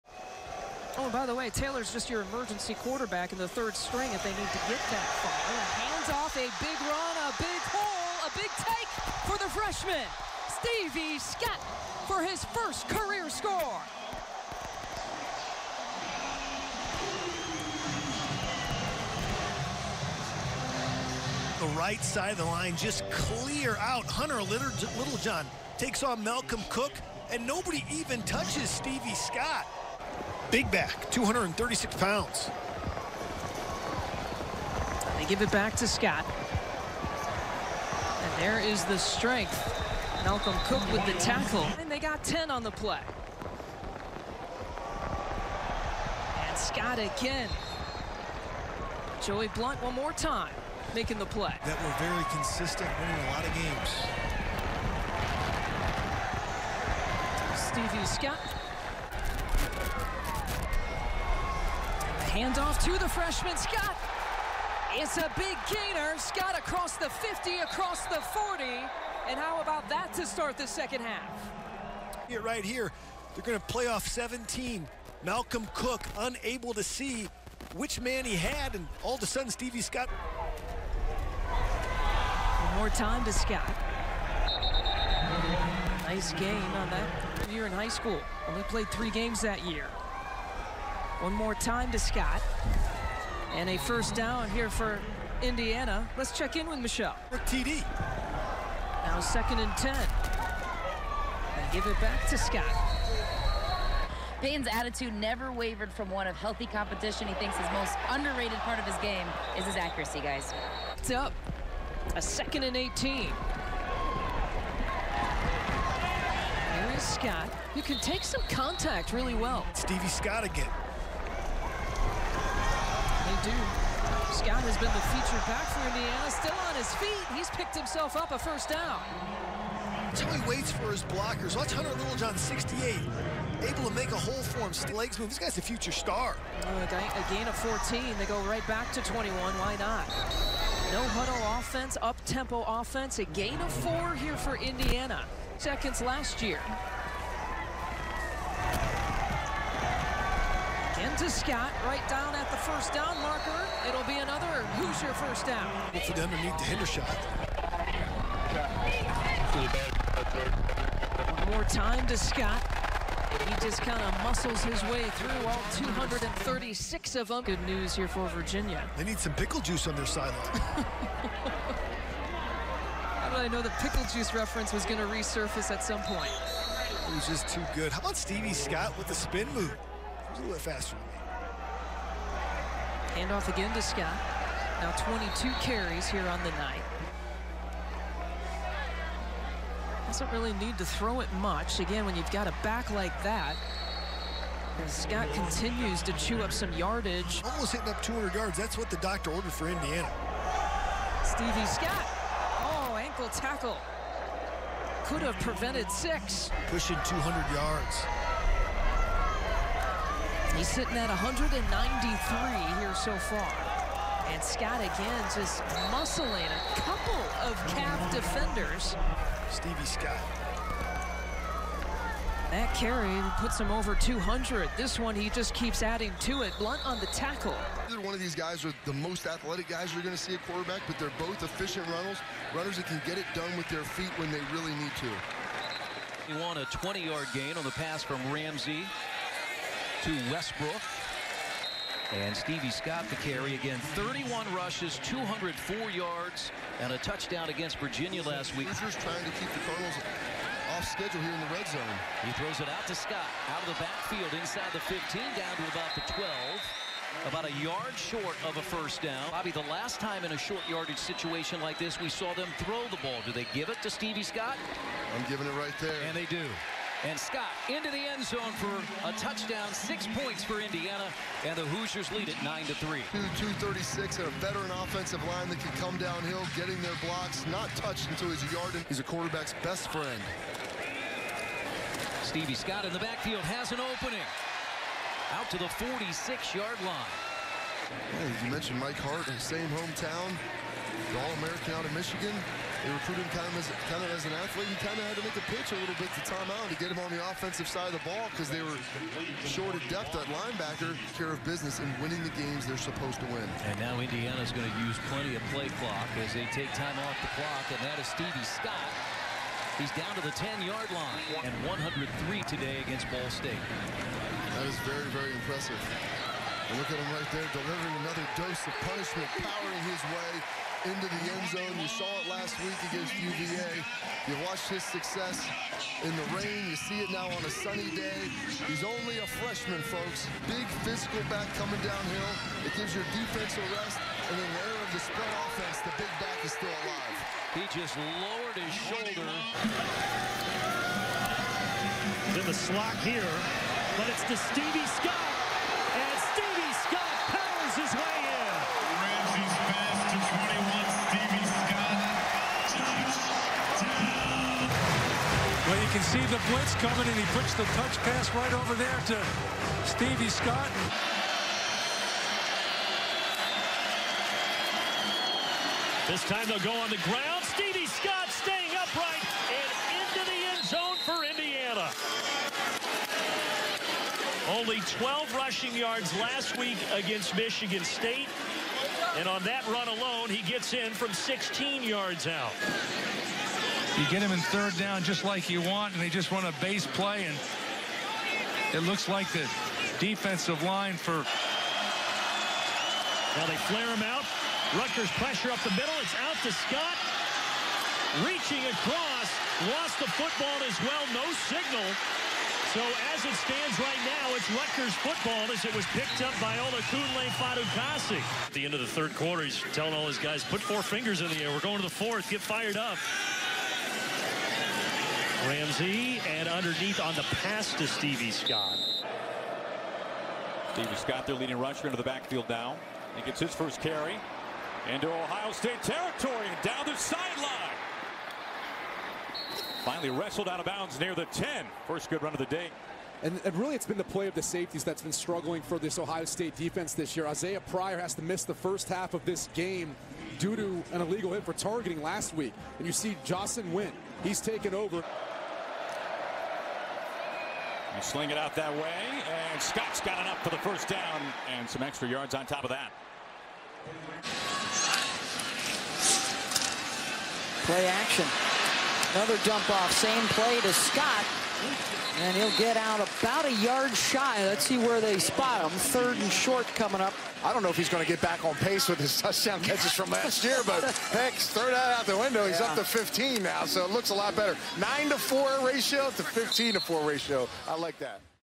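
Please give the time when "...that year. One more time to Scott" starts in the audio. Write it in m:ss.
1:29.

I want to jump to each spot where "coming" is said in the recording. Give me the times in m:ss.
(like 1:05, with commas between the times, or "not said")
5:31, 5:56, 7:46.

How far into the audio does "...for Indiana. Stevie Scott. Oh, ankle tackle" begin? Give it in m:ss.
3:19.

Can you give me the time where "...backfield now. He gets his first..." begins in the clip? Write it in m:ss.
7:02.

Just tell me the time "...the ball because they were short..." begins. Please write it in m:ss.
4:57.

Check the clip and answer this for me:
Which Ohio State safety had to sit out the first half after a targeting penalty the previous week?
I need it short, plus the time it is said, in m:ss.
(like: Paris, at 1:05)
Isaiah Pryor, at 7:17.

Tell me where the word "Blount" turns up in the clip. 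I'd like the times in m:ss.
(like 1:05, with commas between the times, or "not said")
0:49, 3:46.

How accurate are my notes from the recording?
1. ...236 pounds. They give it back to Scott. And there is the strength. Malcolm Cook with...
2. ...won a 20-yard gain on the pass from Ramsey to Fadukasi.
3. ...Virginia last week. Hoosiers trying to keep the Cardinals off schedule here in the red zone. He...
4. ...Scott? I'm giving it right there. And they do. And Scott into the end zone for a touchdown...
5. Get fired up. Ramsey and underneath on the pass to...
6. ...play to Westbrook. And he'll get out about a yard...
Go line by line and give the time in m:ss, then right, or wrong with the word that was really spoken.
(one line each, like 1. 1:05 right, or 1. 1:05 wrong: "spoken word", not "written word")
1. 0:31 right
2. 3:56 wrong: "Westbrook", not "Fadukasi"
3. 4:07 right
4. 4:24 right
5. 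6:52 right
6. 7:40 wrong: "Scott", not "Westbrook".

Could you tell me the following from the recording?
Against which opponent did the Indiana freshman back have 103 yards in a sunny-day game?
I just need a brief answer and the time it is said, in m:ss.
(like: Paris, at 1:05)
Ball State, at 5:13.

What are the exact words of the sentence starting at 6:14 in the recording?
Only 12 rushing yards last week against Michigan State.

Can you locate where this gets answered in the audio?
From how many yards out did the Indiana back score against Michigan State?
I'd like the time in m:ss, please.
6:21.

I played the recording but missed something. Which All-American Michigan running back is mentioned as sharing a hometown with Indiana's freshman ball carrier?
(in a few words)
Mike Hart.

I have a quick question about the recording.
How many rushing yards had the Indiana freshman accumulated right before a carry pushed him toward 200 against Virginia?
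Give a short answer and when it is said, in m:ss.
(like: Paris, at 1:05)
193, at 3:31.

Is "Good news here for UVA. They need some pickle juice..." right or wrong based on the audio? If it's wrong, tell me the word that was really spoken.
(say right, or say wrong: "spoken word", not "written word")
wrong: "Virginia", not "UVA".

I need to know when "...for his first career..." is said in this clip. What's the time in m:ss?
0:12.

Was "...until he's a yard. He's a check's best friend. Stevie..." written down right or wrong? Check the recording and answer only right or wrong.
wrong.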